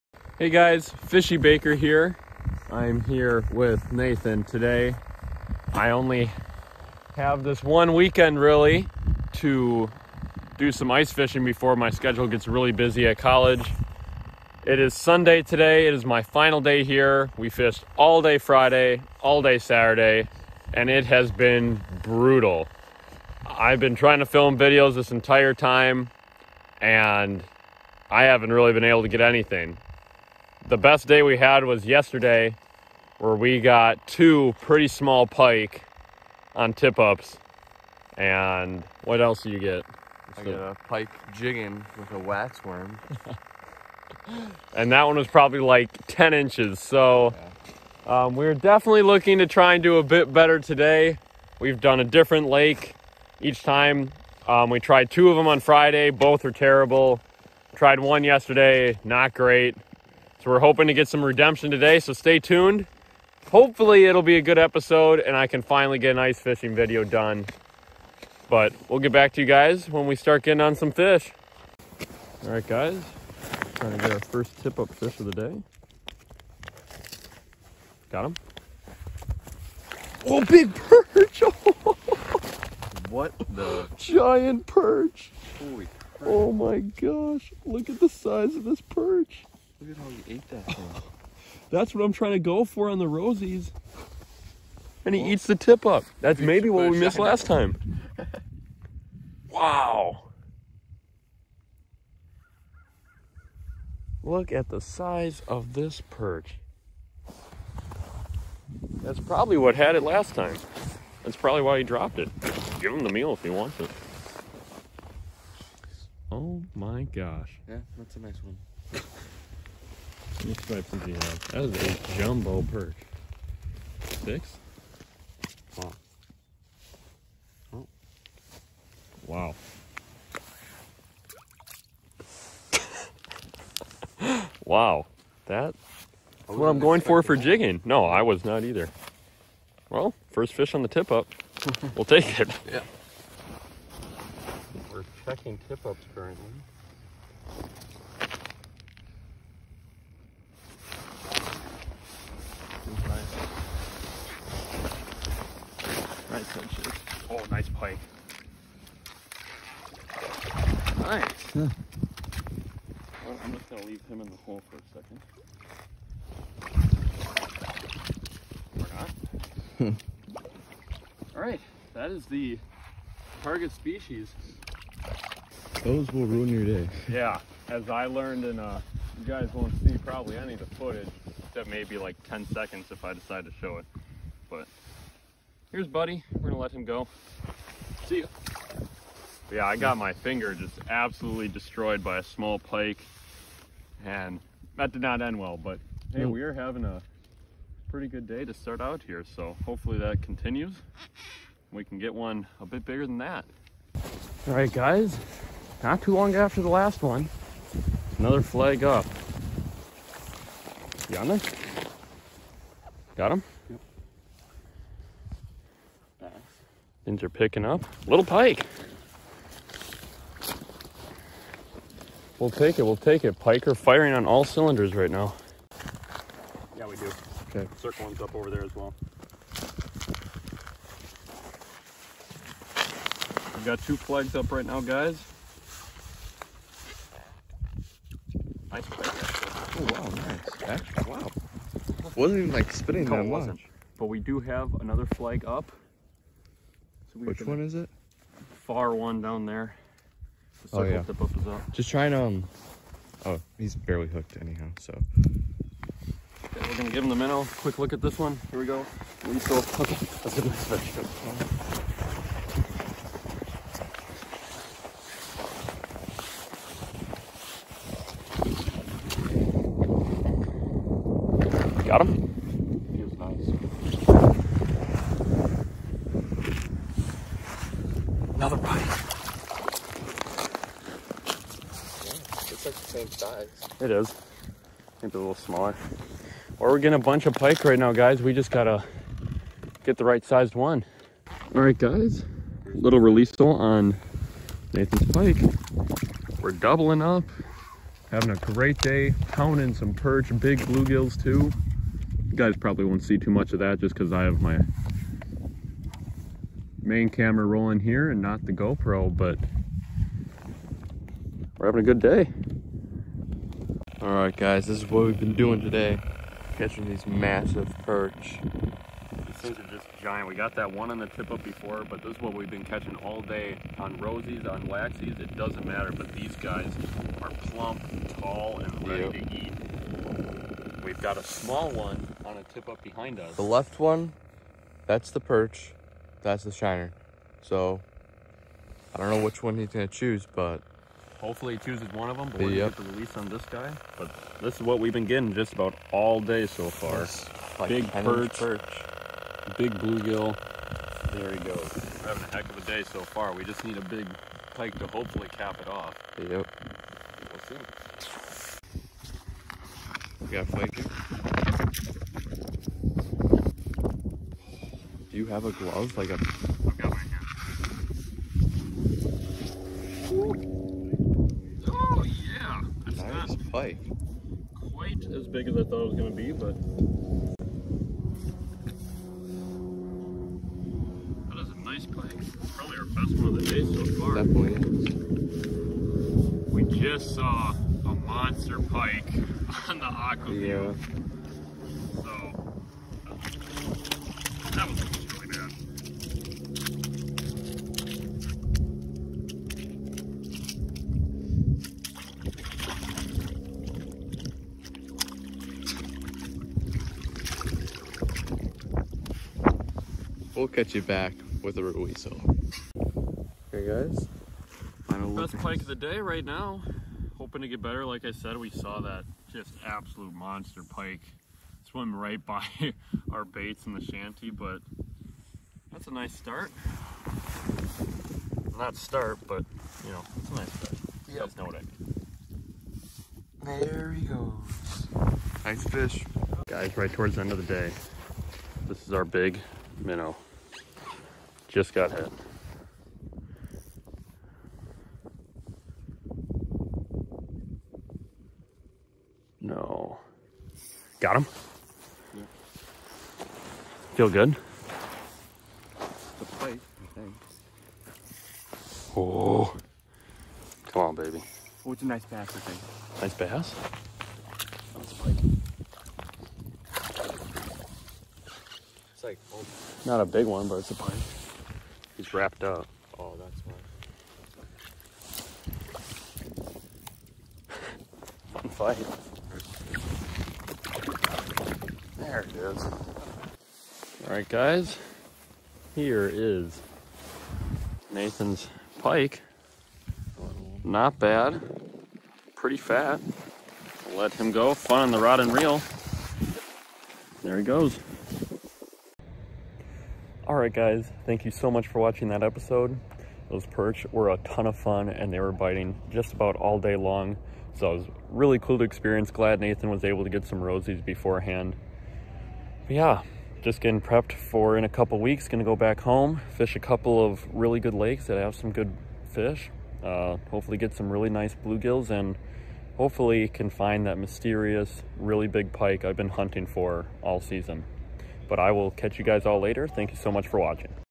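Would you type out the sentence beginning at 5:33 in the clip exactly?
The left one, that's the perch, that's the shiner.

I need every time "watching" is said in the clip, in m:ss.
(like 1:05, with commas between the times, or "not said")
8:21, 8:50.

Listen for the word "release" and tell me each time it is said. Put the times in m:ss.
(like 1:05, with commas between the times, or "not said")
4:52, 5:42.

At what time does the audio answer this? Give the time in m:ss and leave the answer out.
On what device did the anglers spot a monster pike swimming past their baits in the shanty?
6:29.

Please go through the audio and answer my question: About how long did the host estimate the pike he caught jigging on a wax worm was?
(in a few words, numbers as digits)
10 inches.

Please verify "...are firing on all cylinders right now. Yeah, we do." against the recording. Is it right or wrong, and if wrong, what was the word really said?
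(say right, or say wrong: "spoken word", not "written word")
right.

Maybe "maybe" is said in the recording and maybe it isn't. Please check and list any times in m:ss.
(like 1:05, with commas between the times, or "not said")
1:36, 3:01, 4:45.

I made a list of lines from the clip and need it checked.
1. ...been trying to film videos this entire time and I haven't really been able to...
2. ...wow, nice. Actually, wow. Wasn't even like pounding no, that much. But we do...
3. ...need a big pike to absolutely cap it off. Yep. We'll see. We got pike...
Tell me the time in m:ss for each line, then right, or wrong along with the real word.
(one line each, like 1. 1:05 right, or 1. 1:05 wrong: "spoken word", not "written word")
1. 0:23 right
2. 4:00 wrong: "spinning", not "pounding"
3. 5:53 wrong: "hopefully", not "absolutely".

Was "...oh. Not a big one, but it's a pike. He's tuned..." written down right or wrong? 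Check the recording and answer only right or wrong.
wrong.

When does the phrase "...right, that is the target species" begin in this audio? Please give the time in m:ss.
2:51.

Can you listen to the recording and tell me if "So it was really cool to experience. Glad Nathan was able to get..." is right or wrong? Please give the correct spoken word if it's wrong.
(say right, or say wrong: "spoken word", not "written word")
right.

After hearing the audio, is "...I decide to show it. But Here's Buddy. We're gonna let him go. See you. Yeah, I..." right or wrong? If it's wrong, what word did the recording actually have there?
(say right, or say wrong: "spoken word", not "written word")
right.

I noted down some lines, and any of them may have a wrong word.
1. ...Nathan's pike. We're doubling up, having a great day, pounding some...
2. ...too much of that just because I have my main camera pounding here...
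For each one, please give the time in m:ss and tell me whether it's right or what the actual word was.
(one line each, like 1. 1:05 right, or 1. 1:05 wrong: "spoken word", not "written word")
1. 4:54 right
2. 5:03 wrong: "rolling", not "pounding".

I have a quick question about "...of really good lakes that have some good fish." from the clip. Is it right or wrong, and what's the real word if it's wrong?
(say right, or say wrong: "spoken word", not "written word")
right.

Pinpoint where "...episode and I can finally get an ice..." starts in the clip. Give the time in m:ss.
1:04.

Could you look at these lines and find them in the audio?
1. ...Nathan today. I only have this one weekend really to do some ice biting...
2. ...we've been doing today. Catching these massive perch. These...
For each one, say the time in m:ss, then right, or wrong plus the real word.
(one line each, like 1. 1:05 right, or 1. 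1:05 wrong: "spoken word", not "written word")
1. 0:03 wrong: "fishing", not "biting"
2. 5:15 right.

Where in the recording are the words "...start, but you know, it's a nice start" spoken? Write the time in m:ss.
7:08.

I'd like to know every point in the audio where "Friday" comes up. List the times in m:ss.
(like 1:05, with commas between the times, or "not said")
0:18, 0:55.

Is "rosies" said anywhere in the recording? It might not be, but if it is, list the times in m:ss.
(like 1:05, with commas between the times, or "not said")
1:33, 5:23, 8:30.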